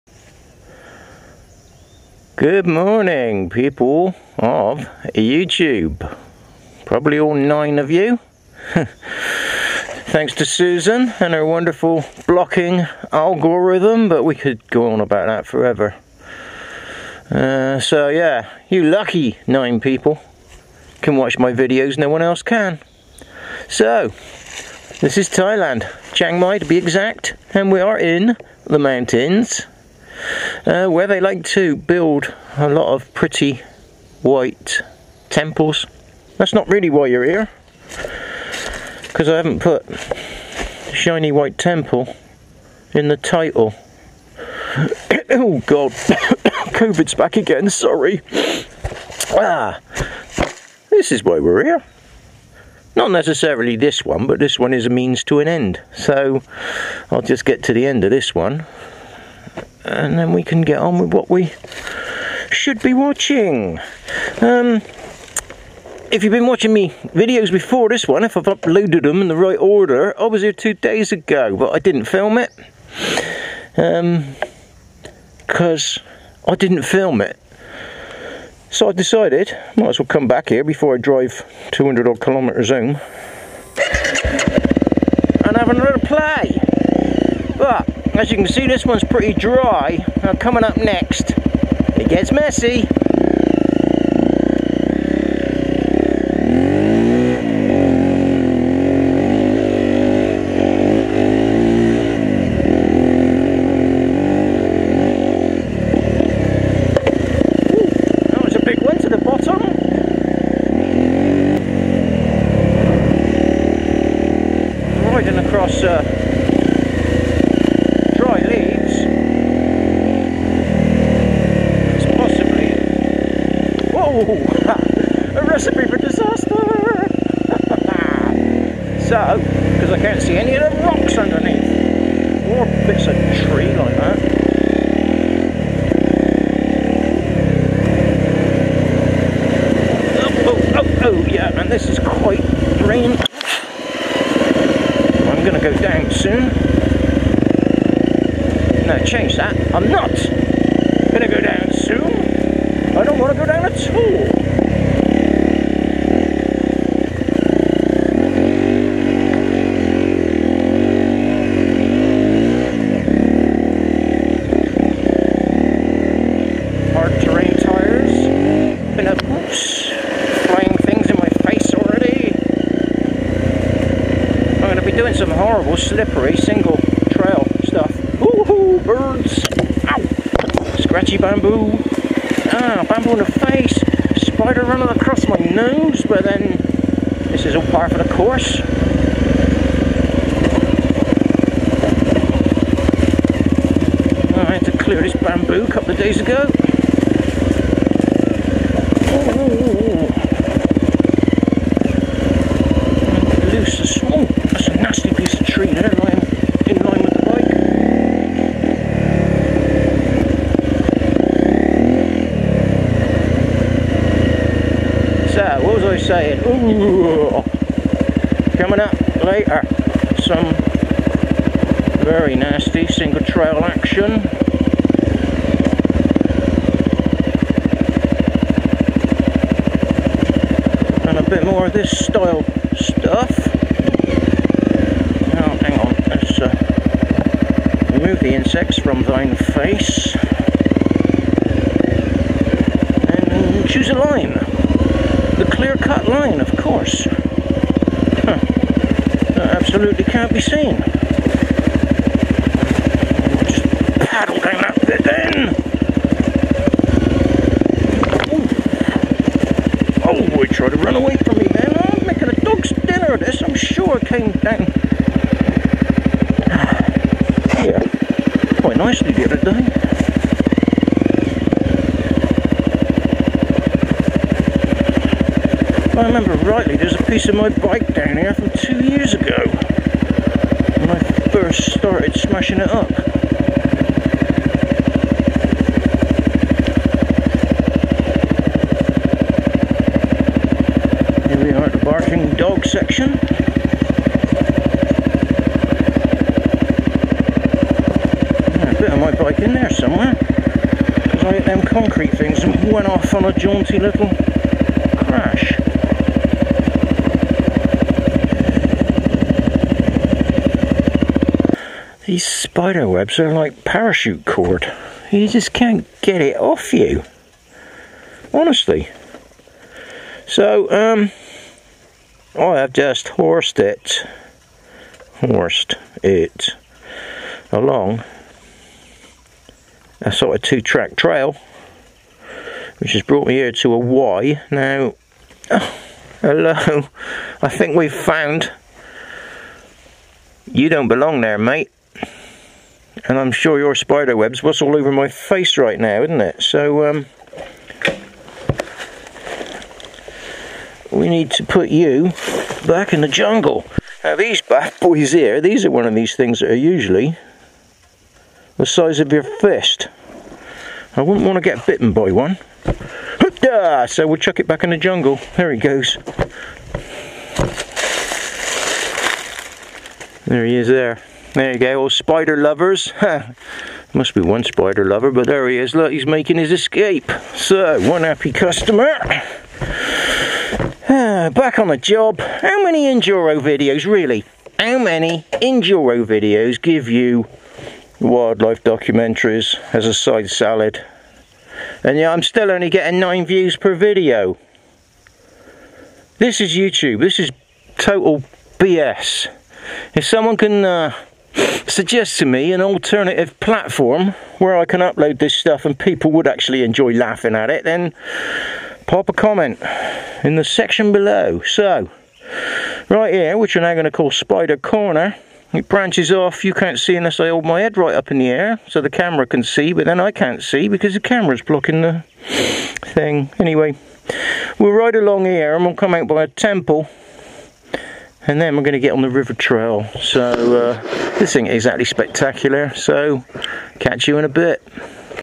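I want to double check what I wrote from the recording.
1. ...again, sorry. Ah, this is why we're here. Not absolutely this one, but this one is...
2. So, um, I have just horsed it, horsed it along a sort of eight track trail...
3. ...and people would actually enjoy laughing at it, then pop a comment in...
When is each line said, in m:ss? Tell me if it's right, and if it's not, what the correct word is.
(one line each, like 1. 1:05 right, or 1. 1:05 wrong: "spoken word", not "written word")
1. 0:47 wrong: "necessarily", not "absolutely"
2. 5:20 wrong: "two", not "eight"
3. 6:45 right.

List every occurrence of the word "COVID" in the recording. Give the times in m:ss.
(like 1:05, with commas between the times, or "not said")
0:45.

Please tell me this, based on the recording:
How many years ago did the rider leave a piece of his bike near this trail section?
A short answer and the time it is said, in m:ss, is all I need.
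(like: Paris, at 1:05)
2 years, at 4:38.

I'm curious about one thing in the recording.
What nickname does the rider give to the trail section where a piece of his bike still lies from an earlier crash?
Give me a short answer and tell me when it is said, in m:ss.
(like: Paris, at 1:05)
the barking dog section, at 4:51.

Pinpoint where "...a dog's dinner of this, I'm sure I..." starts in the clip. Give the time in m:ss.
4:22.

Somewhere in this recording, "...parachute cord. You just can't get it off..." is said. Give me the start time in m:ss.
5:13.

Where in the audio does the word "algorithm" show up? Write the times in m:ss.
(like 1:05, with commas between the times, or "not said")
0:13.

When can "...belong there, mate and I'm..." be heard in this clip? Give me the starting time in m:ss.
5:40.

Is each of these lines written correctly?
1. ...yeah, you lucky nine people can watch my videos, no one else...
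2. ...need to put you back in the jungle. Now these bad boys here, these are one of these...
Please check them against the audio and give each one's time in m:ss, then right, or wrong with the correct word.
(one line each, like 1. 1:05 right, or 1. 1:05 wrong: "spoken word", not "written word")
1. 0:18 right
2. 5:51 right.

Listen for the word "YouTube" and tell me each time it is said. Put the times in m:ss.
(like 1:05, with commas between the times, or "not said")
0:05, 6:36.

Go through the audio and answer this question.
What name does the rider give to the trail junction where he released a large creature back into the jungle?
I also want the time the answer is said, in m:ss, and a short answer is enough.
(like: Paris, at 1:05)
Spider Corner, at 6:54.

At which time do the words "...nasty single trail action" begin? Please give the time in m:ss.
3:42.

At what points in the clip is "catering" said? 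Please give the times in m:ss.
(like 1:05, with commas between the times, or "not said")
not said.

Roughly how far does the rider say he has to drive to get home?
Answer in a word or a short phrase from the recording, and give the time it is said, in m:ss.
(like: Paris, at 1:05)
200 kilometres, at 1:21.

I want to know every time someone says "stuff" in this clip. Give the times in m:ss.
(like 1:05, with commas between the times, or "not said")
2:57, 3:52, 6:45.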